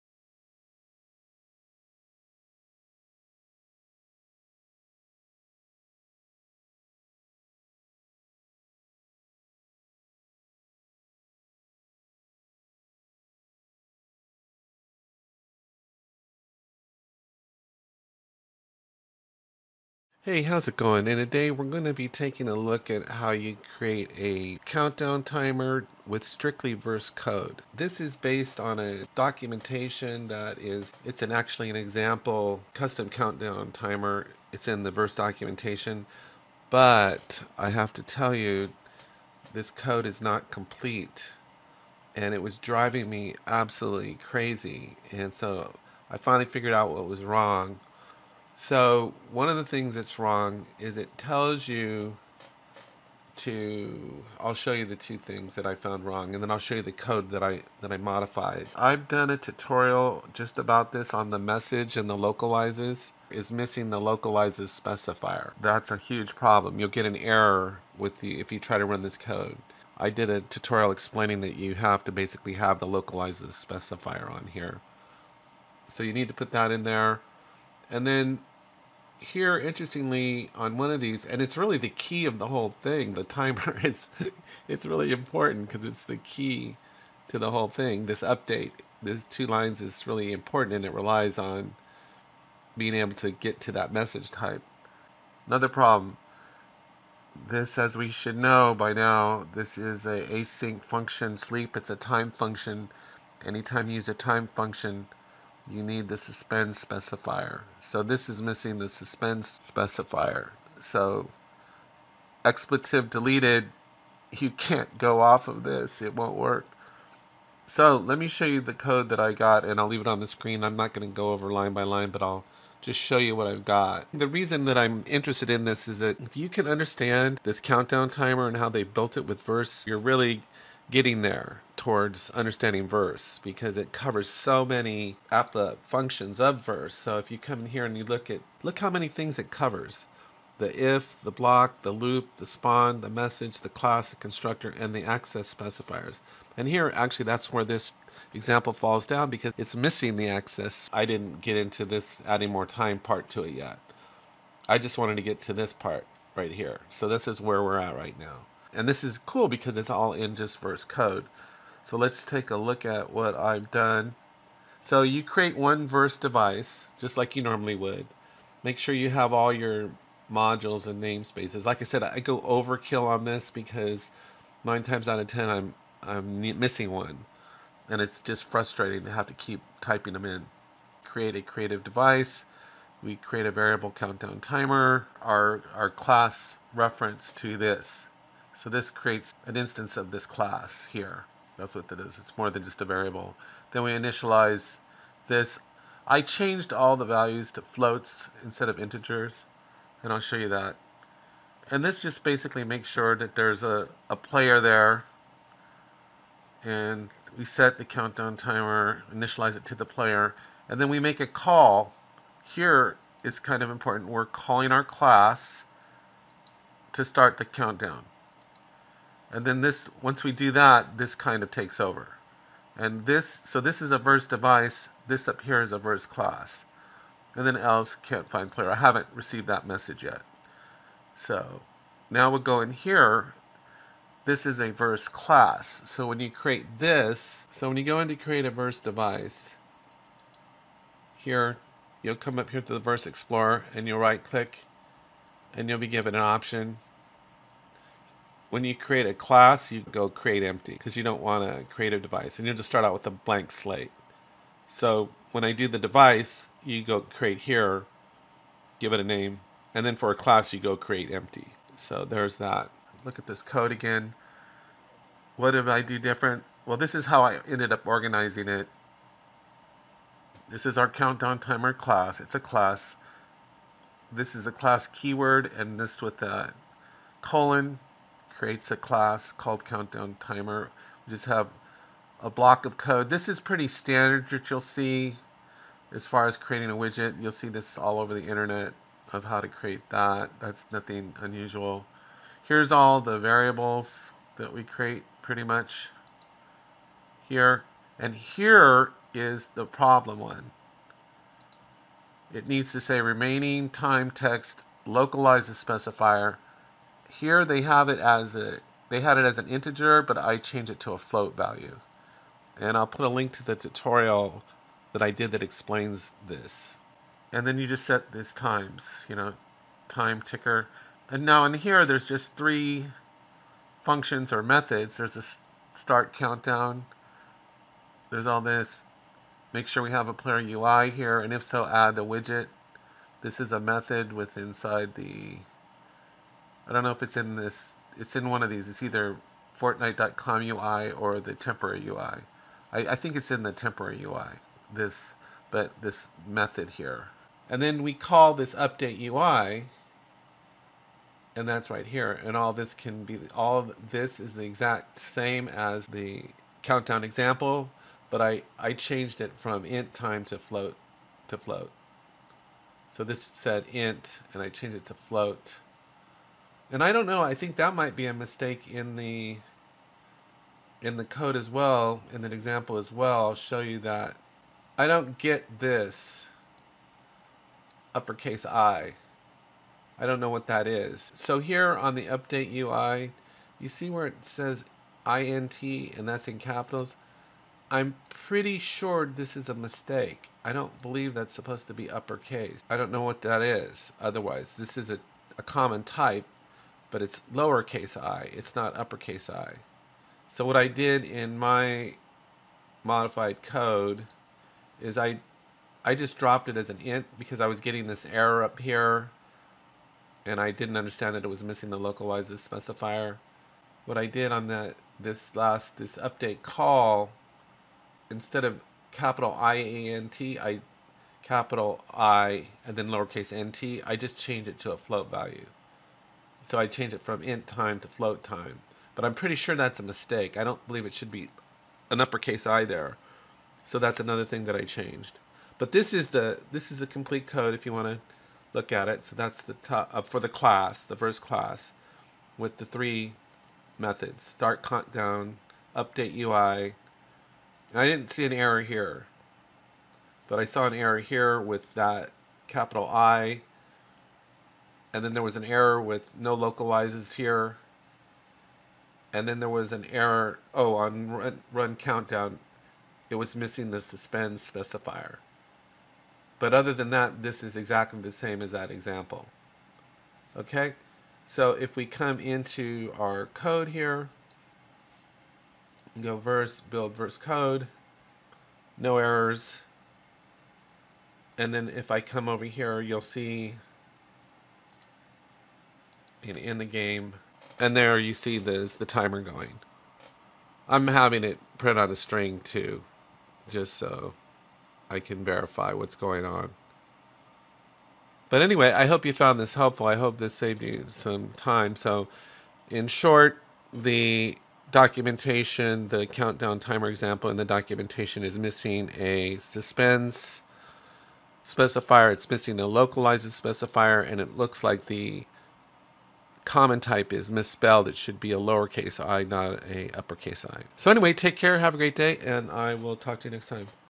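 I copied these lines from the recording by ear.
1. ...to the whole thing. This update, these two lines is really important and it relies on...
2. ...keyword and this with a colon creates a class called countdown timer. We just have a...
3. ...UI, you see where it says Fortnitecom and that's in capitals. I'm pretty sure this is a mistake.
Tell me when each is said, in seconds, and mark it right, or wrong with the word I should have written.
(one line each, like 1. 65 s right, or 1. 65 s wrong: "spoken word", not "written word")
1. 87 s right
2. 274 s right
3. 382 s wrong: "INT", not "Fortnitecom".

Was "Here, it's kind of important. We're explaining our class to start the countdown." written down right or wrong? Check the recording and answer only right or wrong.
wrong.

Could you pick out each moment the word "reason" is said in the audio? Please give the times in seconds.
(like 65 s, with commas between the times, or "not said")
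124 s.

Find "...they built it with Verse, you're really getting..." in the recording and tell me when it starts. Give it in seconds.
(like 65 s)
128 s.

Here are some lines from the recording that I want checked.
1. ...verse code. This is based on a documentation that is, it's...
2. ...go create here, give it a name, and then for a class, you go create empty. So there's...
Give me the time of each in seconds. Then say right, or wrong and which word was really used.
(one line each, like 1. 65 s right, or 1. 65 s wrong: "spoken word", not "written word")
1. 26 s right
2. 256 s right.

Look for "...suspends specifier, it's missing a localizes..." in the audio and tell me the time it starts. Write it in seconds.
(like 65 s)
509 s.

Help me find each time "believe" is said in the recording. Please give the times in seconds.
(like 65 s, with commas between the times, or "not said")
390 s, 430 s.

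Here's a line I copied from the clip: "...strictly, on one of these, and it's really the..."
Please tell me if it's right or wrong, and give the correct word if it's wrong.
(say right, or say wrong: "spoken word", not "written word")
wrong: "interestingly", not "strictly".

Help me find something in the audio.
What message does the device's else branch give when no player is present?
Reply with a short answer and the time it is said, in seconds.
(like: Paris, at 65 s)
can't find player, at 227 s.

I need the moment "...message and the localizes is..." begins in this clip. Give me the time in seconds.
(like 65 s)
61 s.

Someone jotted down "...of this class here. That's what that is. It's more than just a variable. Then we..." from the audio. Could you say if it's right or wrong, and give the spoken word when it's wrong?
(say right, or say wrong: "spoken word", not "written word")
right.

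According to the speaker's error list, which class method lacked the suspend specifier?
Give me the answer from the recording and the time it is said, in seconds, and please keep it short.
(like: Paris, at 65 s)
run countdown, at 461 s.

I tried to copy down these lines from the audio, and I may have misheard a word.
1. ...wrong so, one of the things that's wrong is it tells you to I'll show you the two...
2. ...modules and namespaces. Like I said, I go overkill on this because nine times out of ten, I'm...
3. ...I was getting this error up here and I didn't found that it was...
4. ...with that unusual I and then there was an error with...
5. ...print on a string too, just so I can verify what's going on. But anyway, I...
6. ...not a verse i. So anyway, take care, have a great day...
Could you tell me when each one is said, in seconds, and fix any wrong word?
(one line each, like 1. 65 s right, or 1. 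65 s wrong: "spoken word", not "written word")
1. 47 s right
2. 170 s right
3. 407 s wrong: "understand", not "found"
4. 451 s wrong: "capital", not "unusual"
5. 491 s right
6. 519 s wrong: "uppercase", not "verse".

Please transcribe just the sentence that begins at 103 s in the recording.
Anytime you use a time function, you need the suspend specifier.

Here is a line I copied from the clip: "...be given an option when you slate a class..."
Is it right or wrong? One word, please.
wrong.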